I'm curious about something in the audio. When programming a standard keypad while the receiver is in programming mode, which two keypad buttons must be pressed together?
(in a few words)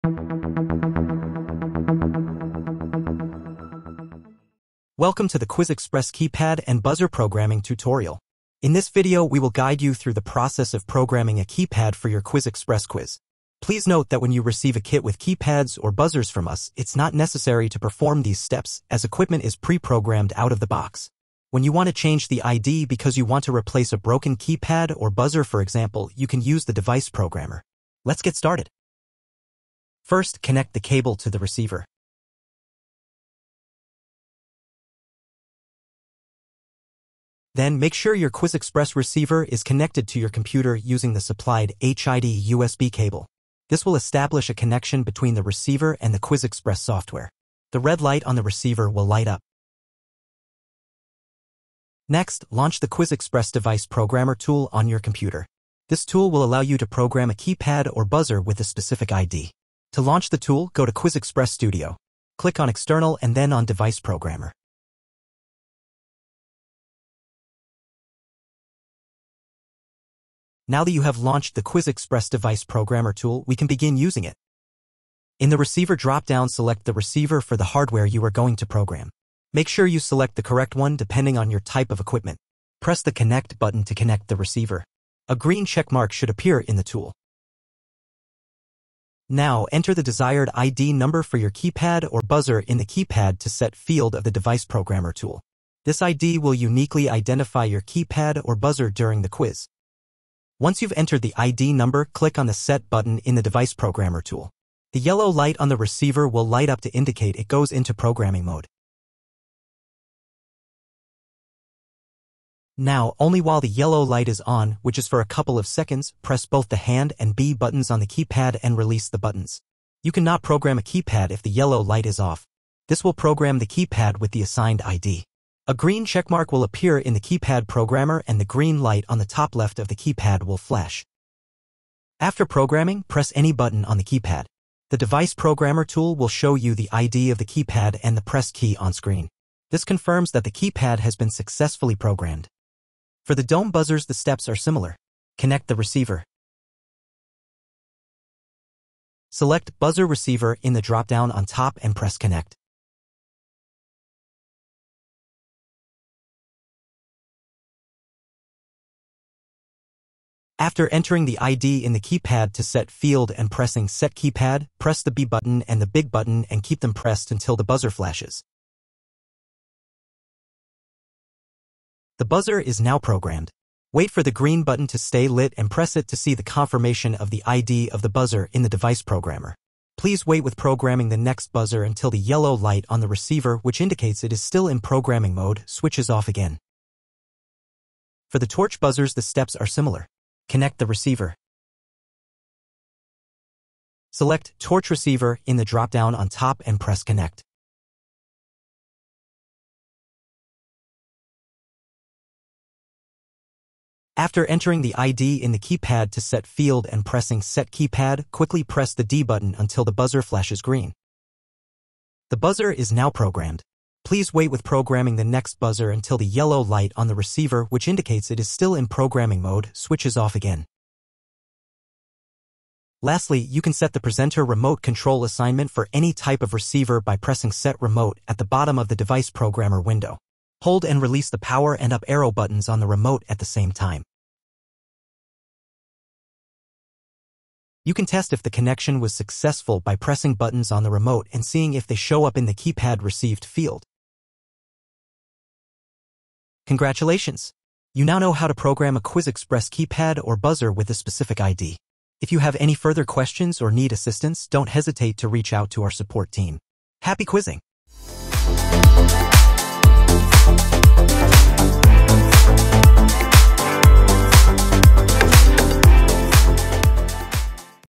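hand and B.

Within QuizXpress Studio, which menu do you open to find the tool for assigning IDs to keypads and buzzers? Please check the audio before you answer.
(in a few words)
External.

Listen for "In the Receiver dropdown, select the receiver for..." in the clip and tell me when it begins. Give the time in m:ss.
1:15.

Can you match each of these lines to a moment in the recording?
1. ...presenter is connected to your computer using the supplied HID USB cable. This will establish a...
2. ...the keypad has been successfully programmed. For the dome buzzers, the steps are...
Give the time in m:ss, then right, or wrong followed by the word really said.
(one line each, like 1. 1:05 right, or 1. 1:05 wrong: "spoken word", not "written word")
1. 0:38 wrong: "receiver", not "presenter"
2. 2:20 right.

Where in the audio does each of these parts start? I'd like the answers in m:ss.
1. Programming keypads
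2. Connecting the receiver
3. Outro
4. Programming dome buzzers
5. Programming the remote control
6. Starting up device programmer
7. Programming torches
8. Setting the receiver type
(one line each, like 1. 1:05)
1. 1:40
2. 0:30
3. 4:06
4. 2:23
5. 3:43
6. 0:51
7. 3:08
8. 1:12.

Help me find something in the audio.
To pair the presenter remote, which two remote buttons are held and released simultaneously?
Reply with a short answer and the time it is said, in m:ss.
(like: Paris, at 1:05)
power and up arrow, at 3:51.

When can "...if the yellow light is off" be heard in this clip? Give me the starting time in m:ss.
2:01.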